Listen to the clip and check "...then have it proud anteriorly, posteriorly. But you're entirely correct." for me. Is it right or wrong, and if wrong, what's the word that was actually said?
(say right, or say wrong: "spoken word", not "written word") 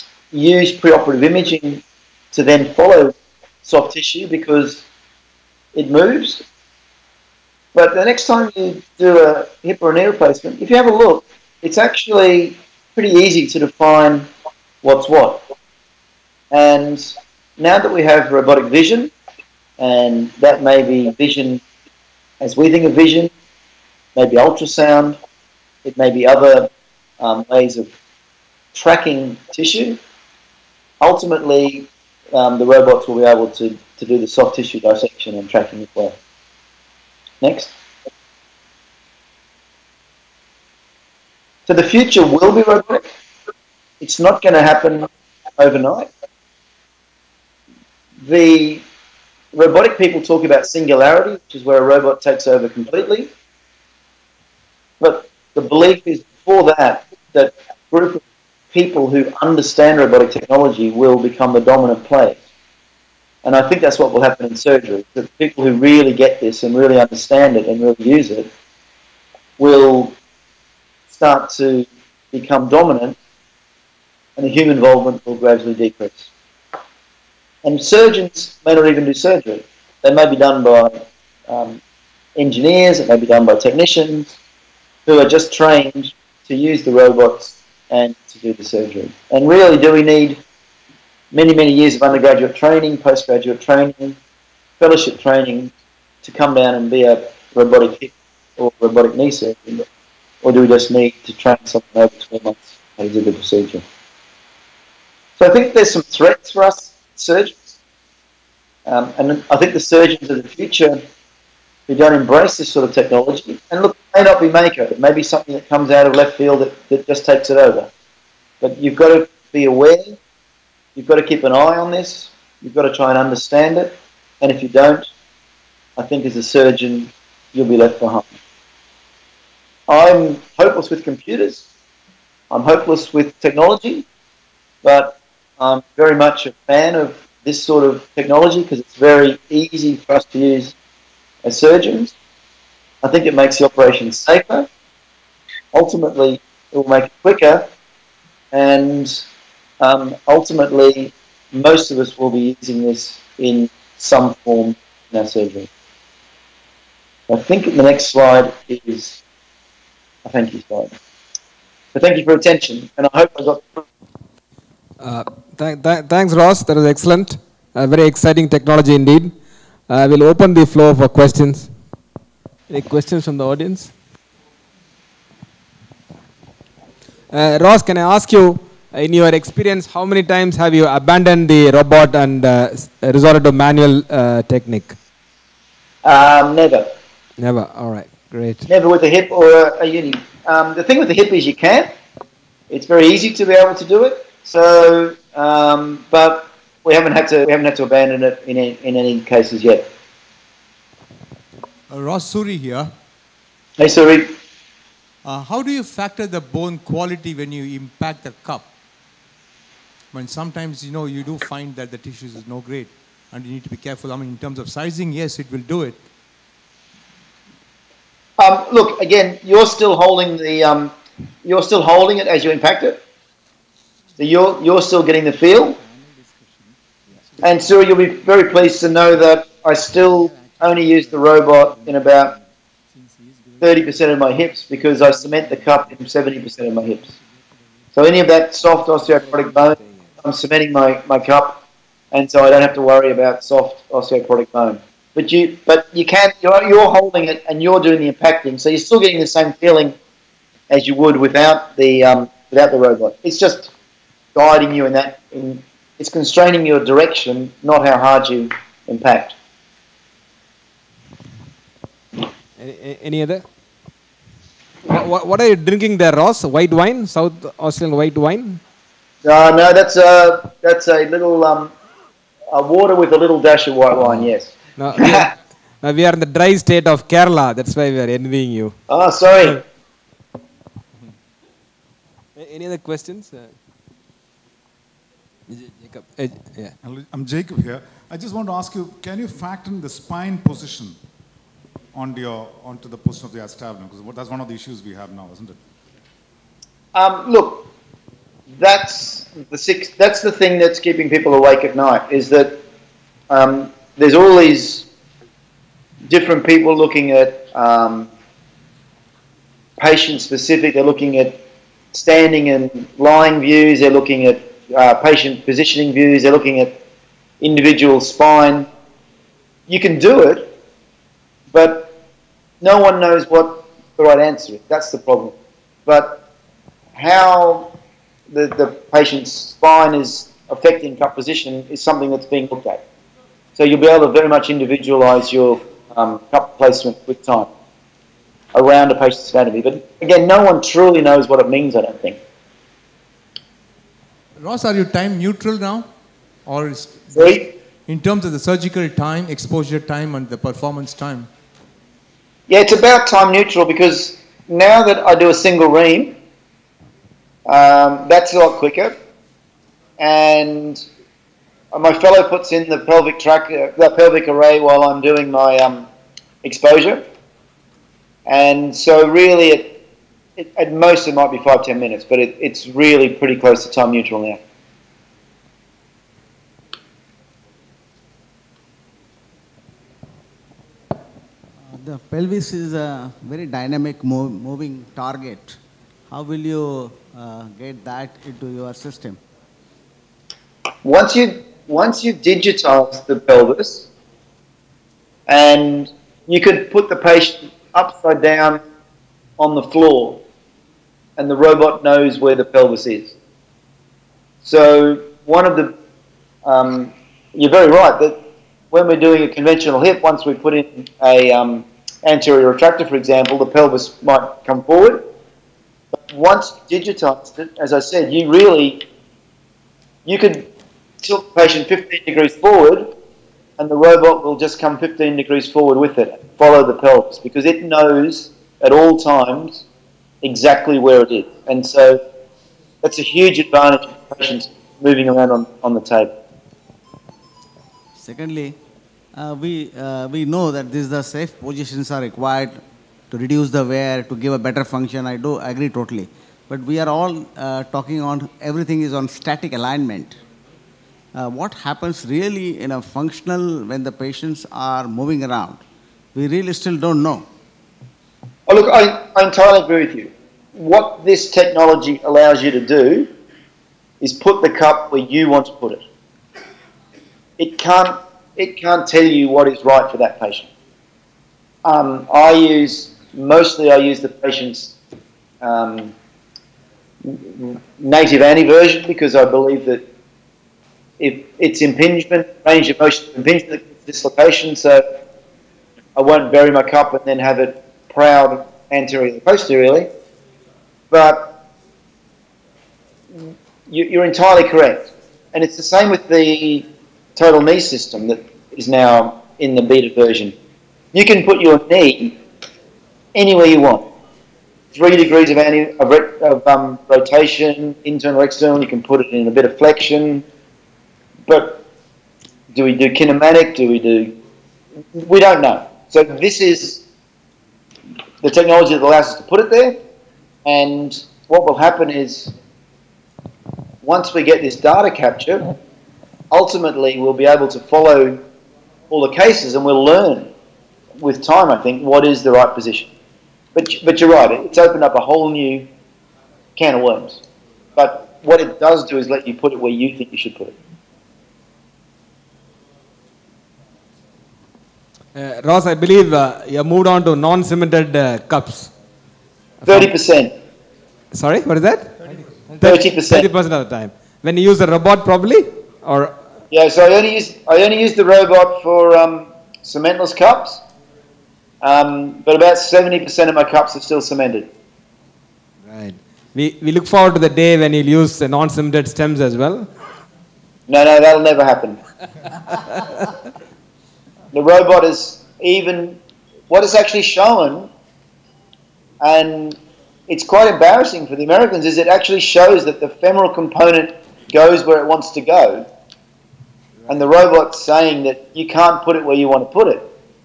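right.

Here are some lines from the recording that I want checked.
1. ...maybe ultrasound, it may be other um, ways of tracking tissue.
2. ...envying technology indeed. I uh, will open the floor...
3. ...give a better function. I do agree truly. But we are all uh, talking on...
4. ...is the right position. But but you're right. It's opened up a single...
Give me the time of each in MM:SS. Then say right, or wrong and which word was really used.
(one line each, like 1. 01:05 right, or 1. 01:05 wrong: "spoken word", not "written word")
1. 00:24 right
2. 02:48 wrong: "exciting", not "envying"
3. 07:24 wrong: "totally", not "truly"
4. 08:52 wrong: "whole", not "single".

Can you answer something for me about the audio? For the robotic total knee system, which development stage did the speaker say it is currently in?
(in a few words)
beta version.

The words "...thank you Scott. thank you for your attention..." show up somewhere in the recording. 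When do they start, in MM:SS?
02:40.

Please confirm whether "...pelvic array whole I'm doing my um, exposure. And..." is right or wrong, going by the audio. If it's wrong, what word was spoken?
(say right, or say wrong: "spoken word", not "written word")
wrong: "while", not "whole".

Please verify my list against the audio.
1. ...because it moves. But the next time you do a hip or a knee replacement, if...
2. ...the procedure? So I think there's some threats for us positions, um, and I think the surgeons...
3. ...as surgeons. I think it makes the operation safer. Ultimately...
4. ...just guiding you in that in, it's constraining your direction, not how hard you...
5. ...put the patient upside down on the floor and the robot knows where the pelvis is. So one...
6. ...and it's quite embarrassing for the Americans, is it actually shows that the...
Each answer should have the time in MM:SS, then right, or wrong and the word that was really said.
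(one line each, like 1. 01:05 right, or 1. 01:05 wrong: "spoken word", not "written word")
1. 00:04 right
2. 01:43 wrong: "surgeons", not "positions"
3. 02:21 right
4. 04:13 right
5. 06:36 right
6. 09:39 right.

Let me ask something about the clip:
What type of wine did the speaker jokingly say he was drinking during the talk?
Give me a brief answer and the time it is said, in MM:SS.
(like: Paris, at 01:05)
South Australian white wine, at 04:27.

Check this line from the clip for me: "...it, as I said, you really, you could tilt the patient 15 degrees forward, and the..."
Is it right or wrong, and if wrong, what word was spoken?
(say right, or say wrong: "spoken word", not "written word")
right.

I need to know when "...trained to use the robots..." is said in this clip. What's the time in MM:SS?
01:25.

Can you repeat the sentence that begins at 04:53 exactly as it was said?
Because that's one of the issues we have now, isn't it?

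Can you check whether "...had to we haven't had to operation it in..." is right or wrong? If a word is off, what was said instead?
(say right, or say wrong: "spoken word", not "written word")
wrong: "abandon", not "operation".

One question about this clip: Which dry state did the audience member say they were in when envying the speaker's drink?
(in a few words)
Kerala.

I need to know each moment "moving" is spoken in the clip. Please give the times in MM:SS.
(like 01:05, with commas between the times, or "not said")
06:24, 07:14, 07:34.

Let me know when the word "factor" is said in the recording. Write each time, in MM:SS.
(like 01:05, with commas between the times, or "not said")
03:25, 04:49.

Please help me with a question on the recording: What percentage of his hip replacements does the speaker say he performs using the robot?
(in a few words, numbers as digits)
30%.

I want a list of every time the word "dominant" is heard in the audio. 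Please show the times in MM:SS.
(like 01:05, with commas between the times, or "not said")
01:01, 01:12.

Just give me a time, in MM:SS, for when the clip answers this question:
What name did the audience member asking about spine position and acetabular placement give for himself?
04:47.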